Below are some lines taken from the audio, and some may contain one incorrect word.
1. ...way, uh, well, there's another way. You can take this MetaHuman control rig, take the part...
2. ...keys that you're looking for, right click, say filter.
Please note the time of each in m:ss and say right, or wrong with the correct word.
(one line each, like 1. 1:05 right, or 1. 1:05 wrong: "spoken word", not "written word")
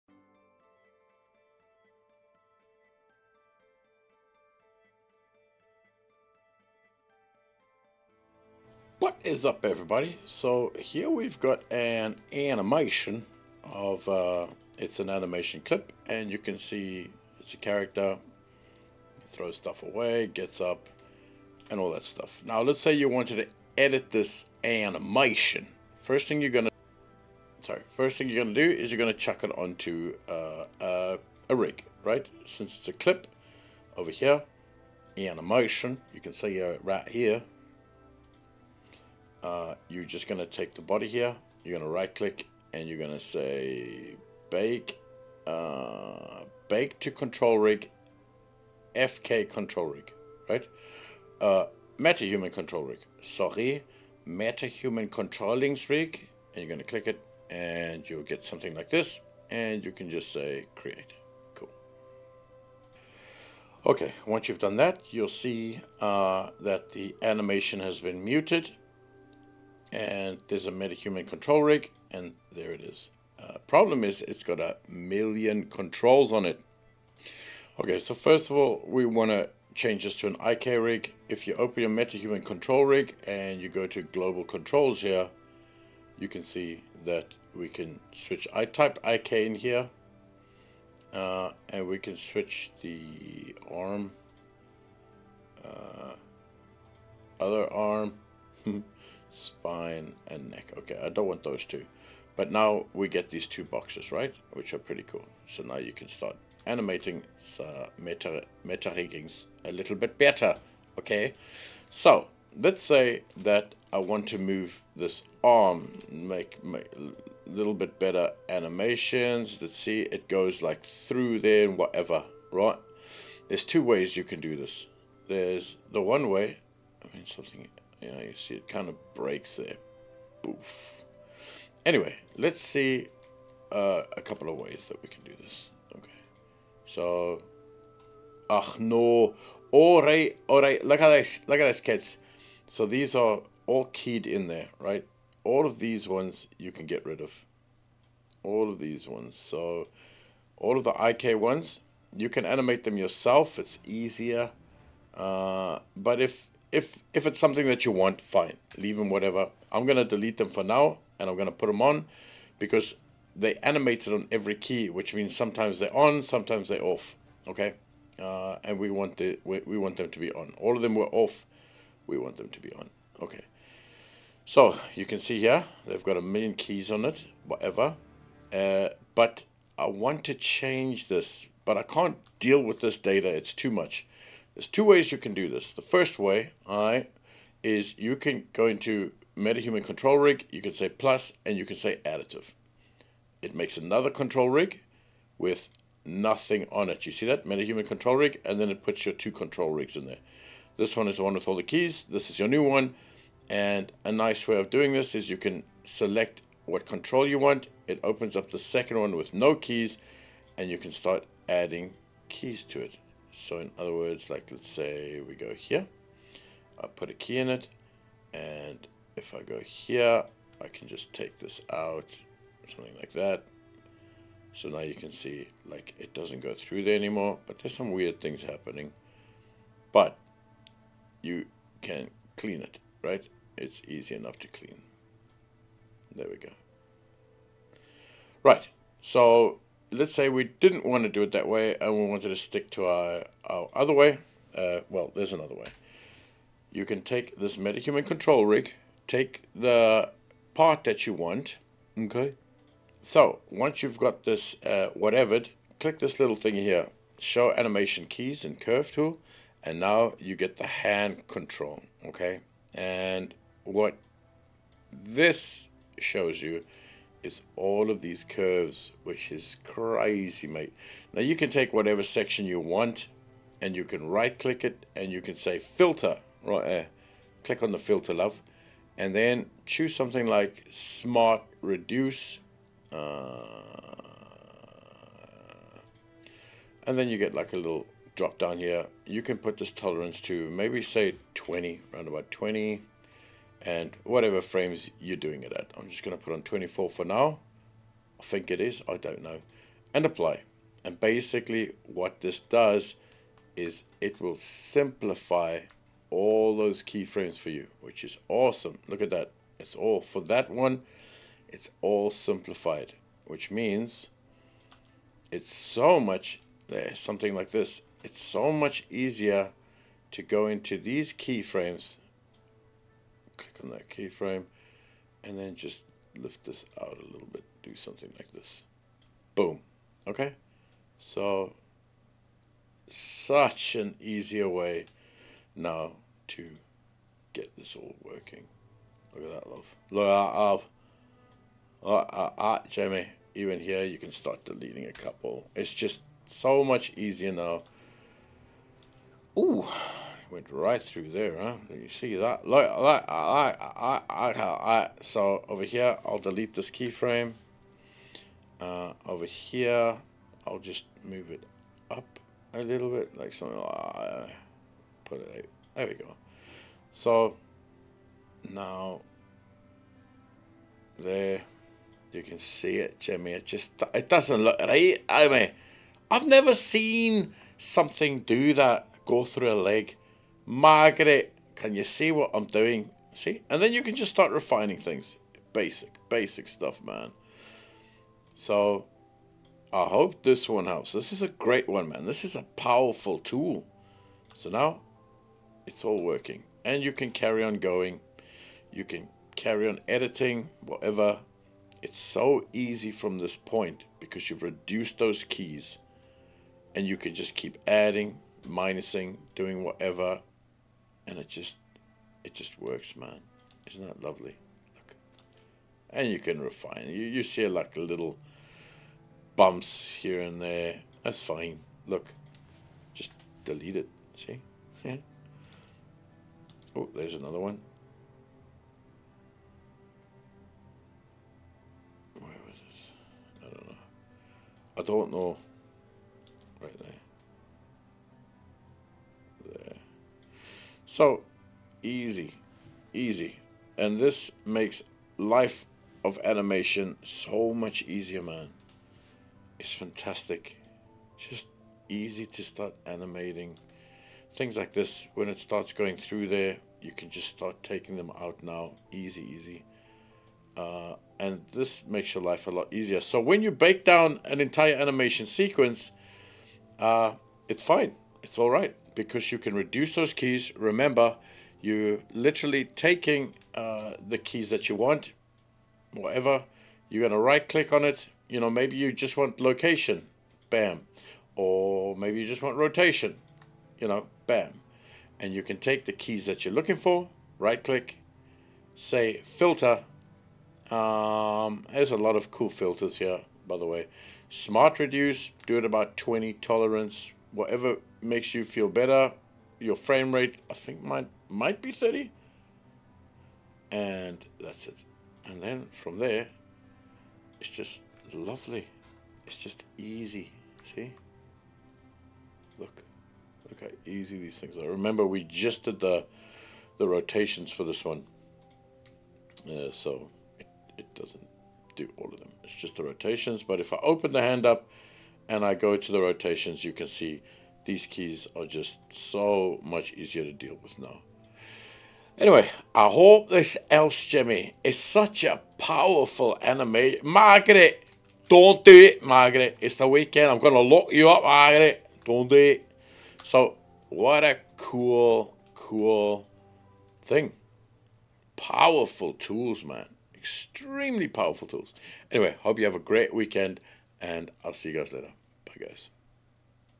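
1. 4:03 right
2. 8:05 right.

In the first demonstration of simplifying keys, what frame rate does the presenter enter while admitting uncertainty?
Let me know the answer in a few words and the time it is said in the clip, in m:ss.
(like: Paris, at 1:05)
24, at 4:56.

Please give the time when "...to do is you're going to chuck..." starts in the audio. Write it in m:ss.
0:28.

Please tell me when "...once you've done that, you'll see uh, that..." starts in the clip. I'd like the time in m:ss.
1:04.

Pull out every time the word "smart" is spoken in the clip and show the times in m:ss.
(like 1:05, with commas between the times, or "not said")
4:40, 8:14.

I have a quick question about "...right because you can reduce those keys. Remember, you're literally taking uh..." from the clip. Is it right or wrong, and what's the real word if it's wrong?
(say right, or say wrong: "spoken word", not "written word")
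right.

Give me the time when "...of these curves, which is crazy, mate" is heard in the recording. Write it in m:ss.
4:27.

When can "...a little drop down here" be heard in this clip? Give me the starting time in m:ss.
4:47.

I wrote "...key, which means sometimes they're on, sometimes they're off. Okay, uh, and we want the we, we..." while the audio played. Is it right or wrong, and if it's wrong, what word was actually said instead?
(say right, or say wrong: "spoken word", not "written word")
right.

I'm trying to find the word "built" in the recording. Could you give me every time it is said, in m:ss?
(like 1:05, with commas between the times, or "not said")
not said.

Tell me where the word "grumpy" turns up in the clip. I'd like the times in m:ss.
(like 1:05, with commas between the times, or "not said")
not said.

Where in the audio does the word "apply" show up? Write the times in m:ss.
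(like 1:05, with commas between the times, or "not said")
5:00.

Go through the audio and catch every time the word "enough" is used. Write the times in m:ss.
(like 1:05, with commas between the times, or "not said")
3:54.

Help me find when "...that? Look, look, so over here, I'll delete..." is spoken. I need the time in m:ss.
5:52.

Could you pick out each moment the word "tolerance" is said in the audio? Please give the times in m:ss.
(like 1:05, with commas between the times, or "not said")
4:49, 8:16.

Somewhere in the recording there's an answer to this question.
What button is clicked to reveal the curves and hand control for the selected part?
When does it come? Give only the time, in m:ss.
4:17.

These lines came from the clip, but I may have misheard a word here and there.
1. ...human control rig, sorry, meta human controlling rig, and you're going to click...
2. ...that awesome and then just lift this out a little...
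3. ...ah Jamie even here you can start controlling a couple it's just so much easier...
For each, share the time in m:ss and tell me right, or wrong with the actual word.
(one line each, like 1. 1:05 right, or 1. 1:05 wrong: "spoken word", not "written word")
1. 0:52 right
2. 5:23 wrong: "keyframe", not "awesome"
3. 5:42 wrong: "deleting", not "controlling".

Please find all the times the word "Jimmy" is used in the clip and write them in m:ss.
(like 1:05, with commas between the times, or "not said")
6:13, 8:54.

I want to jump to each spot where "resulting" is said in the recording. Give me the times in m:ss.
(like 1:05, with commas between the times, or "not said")
not said.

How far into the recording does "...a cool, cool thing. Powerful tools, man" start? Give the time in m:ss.
9:04.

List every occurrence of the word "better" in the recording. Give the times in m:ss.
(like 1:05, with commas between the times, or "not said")
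1:50, 1:57, 8:18.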